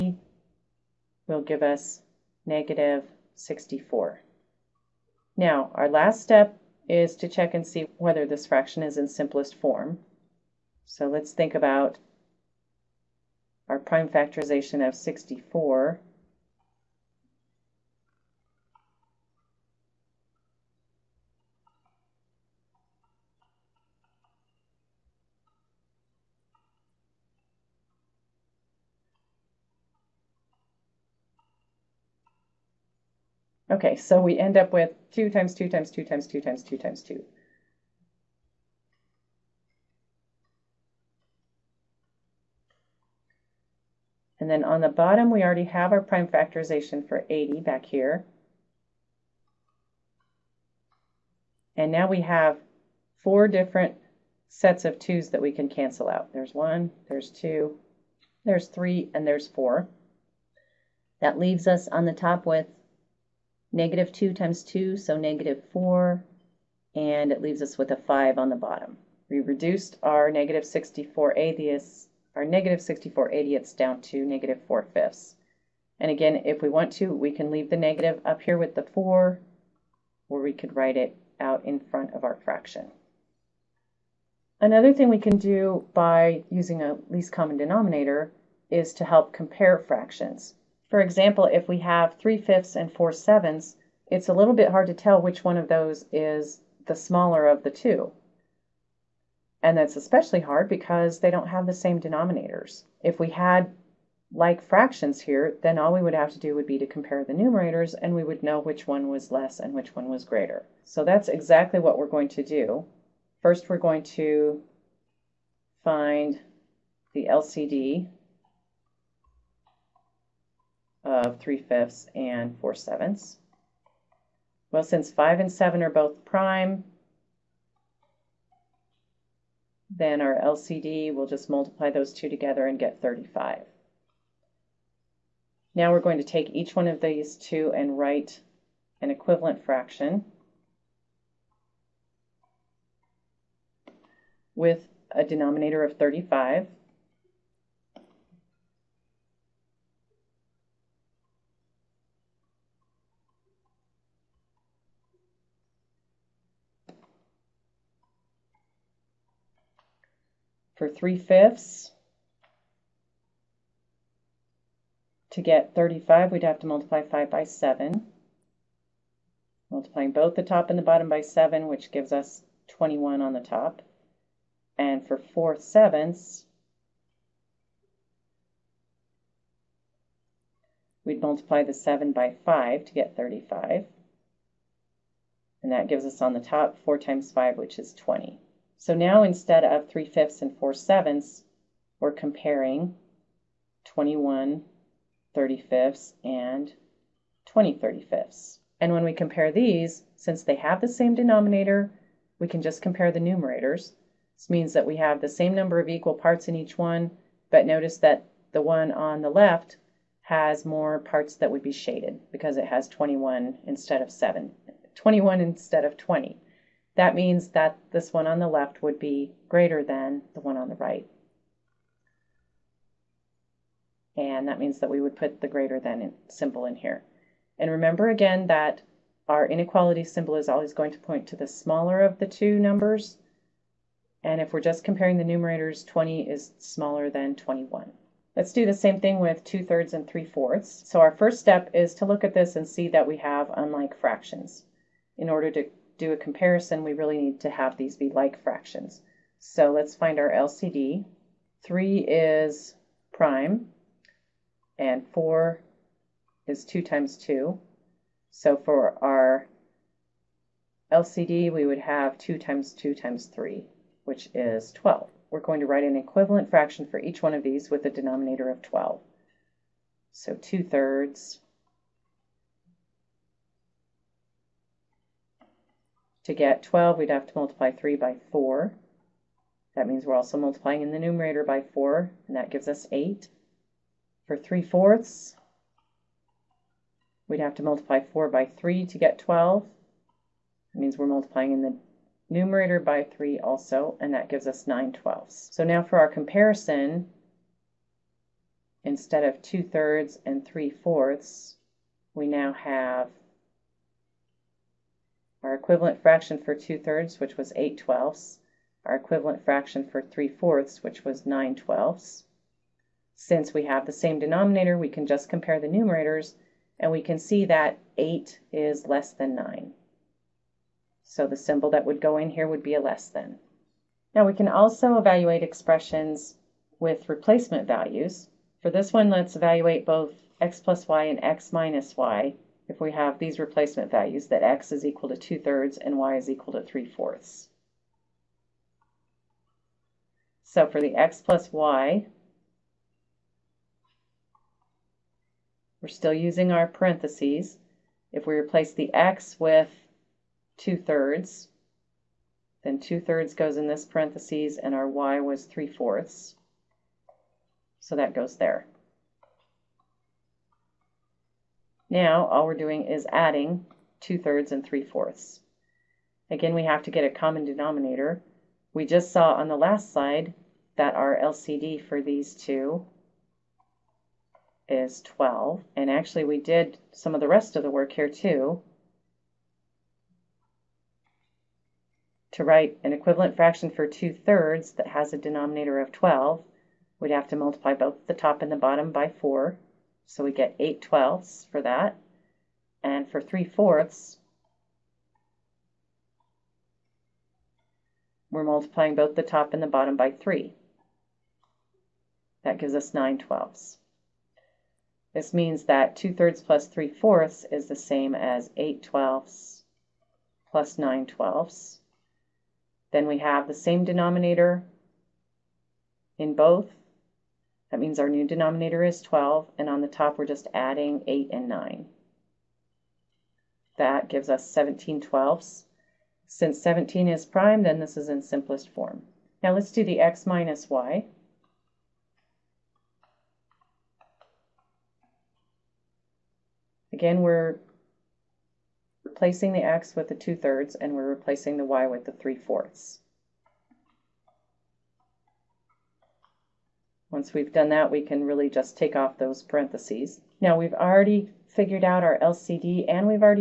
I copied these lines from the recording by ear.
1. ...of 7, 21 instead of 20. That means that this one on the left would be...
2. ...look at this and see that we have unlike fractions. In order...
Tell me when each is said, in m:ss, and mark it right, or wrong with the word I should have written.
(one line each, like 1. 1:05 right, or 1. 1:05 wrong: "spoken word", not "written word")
1. 3:34 right
2. 4:02 right.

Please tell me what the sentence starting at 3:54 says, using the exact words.
And if we're just comparing the numerators, 20 is smaller than 21.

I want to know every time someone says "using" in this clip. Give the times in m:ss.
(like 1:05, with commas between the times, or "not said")
1:26, 5:46.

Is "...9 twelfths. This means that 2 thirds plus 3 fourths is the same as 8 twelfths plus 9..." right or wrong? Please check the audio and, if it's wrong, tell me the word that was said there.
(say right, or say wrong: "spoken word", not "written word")
right.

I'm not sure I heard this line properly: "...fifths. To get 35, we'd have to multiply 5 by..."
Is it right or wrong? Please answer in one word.
right.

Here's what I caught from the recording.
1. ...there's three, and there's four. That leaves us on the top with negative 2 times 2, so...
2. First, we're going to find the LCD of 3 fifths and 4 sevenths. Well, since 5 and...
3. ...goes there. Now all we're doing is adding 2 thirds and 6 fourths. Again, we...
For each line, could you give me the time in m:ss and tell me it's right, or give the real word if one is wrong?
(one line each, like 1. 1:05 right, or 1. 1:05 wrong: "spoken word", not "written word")
1. 0:58 right
2. 1:53 right
3. 5:58 wrong: "3", not "6".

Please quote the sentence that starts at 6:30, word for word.
So we get 8 twelfths for that.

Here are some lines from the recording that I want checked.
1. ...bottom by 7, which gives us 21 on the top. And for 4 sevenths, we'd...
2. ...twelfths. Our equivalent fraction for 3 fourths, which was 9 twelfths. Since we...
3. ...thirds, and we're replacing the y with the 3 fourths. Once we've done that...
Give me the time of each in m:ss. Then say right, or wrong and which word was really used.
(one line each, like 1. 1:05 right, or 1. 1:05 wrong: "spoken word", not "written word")
1. 2:50 right
2. 5:07 right
3. 7:20 right.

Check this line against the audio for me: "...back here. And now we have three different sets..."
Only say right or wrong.
wrong.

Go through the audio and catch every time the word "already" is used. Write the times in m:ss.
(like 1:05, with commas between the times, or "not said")
0:45, 7:30.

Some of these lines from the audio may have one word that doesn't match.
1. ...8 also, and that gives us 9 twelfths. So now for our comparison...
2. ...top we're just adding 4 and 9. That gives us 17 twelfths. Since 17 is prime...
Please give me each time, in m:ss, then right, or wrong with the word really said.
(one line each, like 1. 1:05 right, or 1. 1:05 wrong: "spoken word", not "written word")
1. 4:53 wrong: "3", not "8"
2. 6:59 wrong: "8", not "4".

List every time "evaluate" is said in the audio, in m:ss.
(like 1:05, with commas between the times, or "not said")
5:24, 5:29.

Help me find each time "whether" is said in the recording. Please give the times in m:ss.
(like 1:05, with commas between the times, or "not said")
0:07.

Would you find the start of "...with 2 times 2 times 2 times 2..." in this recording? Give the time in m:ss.
0:34.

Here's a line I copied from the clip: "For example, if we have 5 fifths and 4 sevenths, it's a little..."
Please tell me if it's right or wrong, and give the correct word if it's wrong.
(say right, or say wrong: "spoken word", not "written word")
wrong: "3", not "5".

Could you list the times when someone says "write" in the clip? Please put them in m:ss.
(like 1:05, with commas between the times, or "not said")
1:20, 2:17, 4:25, 6:22.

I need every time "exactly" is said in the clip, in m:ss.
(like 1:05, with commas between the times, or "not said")
1:51.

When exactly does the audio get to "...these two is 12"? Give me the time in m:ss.
6:12.